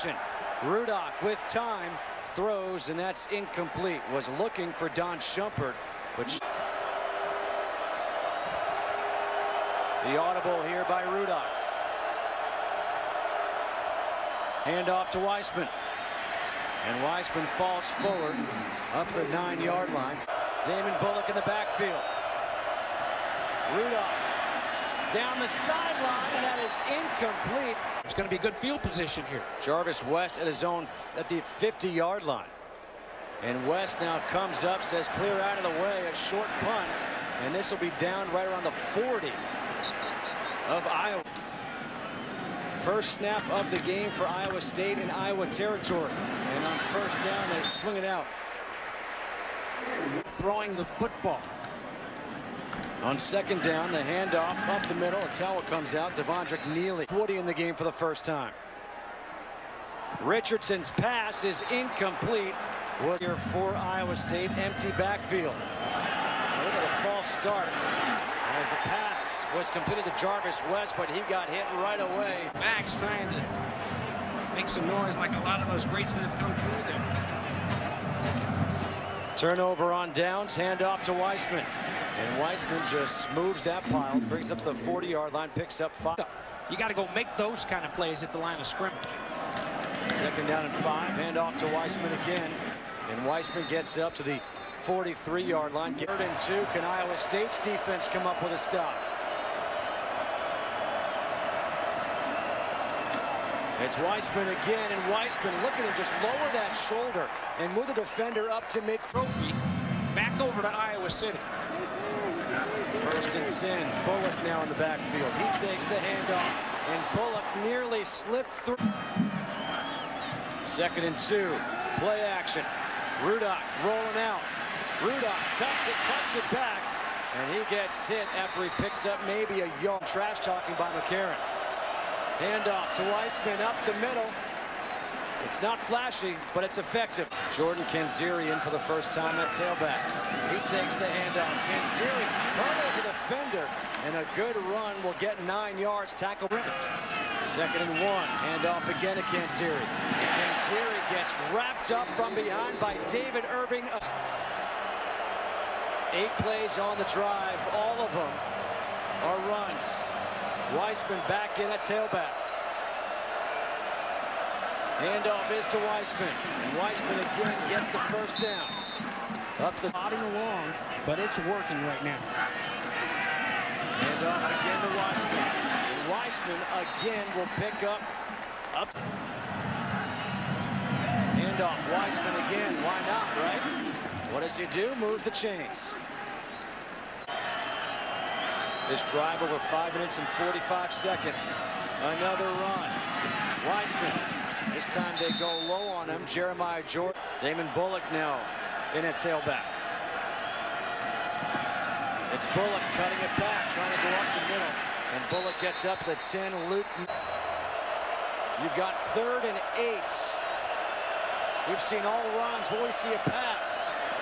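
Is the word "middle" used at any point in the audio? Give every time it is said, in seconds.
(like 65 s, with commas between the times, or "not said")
54 s, 133 s, 204 s.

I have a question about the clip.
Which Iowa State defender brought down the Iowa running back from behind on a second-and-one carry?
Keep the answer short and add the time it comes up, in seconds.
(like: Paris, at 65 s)
David Irving, at 153 s.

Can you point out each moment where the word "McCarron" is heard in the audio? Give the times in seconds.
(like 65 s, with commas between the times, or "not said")
130 s.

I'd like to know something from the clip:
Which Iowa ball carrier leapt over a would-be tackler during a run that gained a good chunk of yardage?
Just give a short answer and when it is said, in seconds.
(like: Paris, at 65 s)
Jordan Canzeri, at 141 s.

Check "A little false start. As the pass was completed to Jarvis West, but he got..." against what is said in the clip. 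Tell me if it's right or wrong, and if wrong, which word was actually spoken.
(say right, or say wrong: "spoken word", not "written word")
right.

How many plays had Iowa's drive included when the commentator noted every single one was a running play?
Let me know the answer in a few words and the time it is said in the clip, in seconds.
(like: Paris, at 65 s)
8, at 156 s.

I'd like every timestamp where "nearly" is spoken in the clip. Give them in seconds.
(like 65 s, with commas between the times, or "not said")
117 s.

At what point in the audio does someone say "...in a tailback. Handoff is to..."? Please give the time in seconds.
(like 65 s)
161 s.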